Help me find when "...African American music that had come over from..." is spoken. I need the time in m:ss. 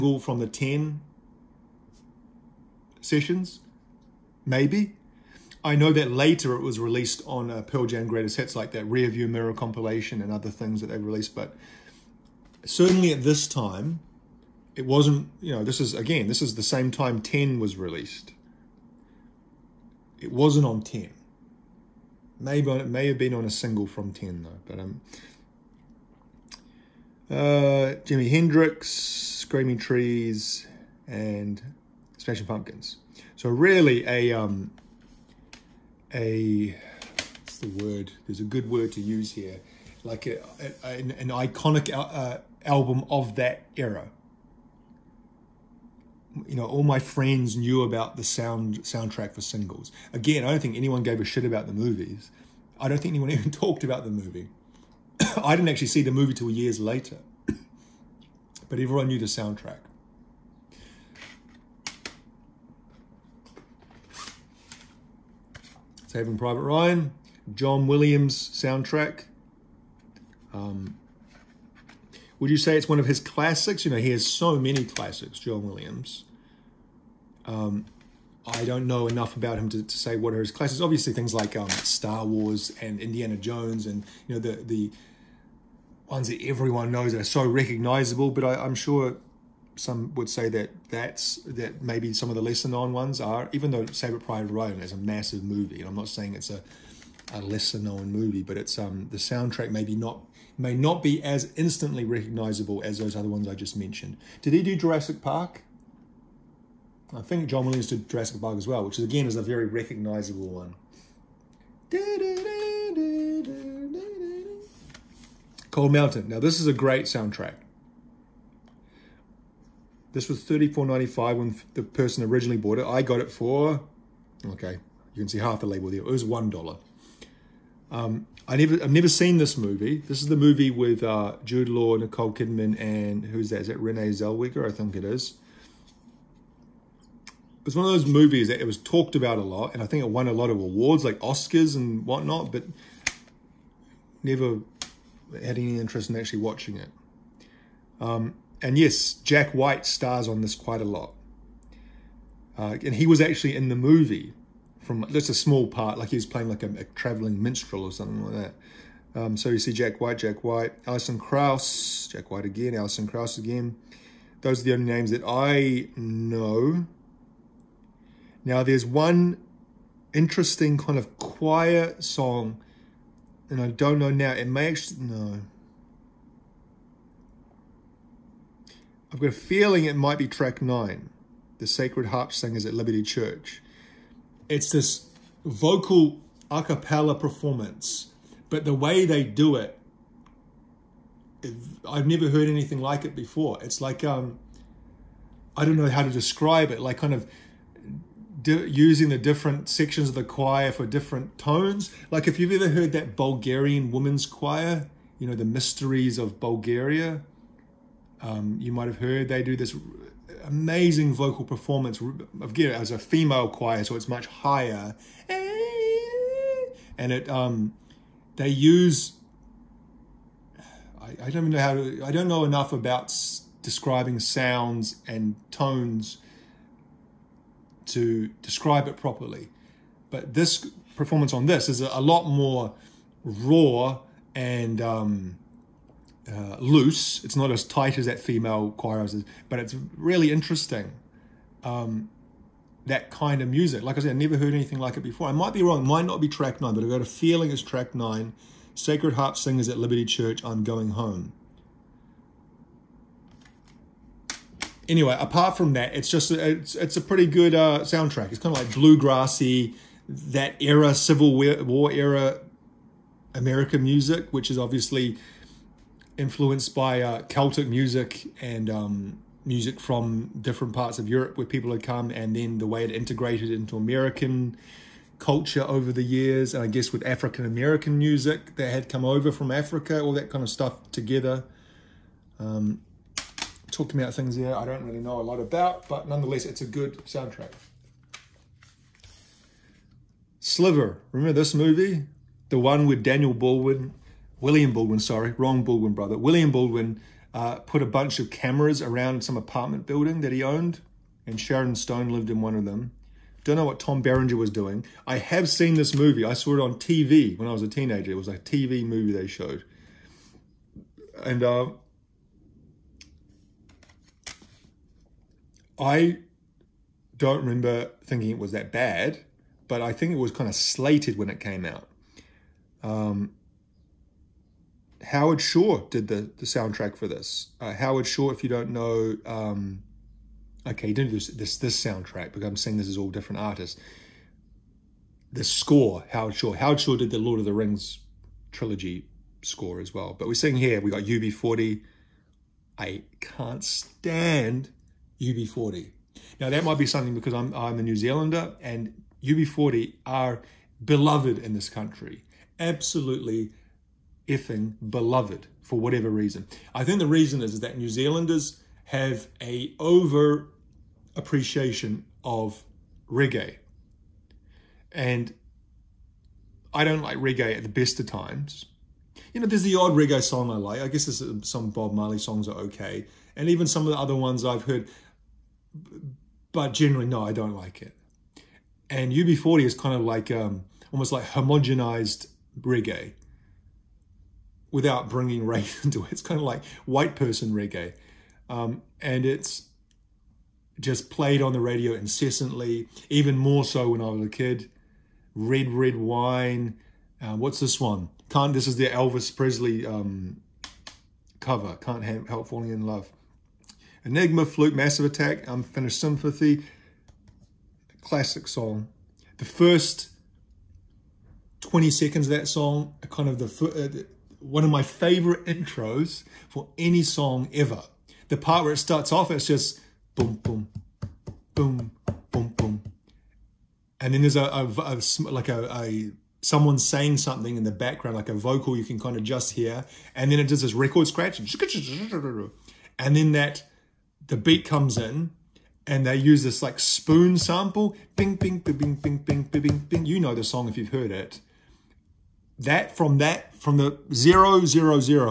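4:37.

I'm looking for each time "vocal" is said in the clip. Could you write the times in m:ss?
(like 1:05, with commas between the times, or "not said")
3:05, 3:31, 7:08.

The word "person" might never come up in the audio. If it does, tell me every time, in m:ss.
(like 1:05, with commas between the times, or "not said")
2:01, 6:27.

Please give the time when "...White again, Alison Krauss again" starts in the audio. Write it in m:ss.
2:42.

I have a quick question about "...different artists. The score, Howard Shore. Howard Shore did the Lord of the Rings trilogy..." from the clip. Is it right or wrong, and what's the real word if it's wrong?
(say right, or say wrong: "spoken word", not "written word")
right.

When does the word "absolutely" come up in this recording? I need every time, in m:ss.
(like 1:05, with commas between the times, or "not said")
5:52.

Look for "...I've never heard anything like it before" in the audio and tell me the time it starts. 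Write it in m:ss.
3:11.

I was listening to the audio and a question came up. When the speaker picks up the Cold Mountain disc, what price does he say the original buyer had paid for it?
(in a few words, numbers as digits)
$34.95.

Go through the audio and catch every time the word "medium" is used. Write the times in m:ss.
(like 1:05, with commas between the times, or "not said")
not said.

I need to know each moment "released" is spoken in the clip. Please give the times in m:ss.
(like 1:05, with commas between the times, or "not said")
0:06, 0:10, 0:17.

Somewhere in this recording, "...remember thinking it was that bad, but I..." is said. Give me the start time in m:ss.
5:17.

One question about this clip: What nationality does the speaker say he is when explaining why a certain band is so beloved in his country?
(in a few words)
New Zealander.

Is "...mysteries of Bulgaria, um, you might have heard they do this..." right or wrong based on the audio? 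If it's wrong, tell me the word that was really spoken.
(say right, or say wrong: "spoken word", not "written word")
right.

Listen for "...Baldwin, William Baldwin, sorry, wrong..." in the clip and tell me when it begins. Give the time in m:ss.
4:53.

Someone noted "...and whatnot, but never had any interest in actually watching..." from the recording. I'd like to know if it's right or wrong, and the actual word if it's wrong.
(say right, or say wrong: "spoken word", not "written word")
right.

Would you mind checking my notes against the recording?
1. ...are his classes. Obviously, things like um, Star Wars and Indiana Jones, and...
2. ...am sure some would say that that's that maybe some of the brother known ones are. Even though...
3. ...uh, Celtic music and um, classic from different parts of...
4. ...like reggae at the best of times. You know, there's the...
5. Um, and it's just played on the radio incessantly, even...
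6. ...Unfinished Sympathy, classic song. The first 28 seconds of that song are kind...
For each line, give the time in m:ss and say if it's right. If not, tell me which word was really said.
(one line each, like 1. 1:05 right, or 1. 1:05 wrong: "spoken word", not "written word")
1. 1:20 right
2. 1:28 wrong: "lesser", not "brother"
3. 4:27 wrong: "music", not "classic"
4. 6:07 right
5. 6:28 right
6. 6:45 wrong: "20", not "28".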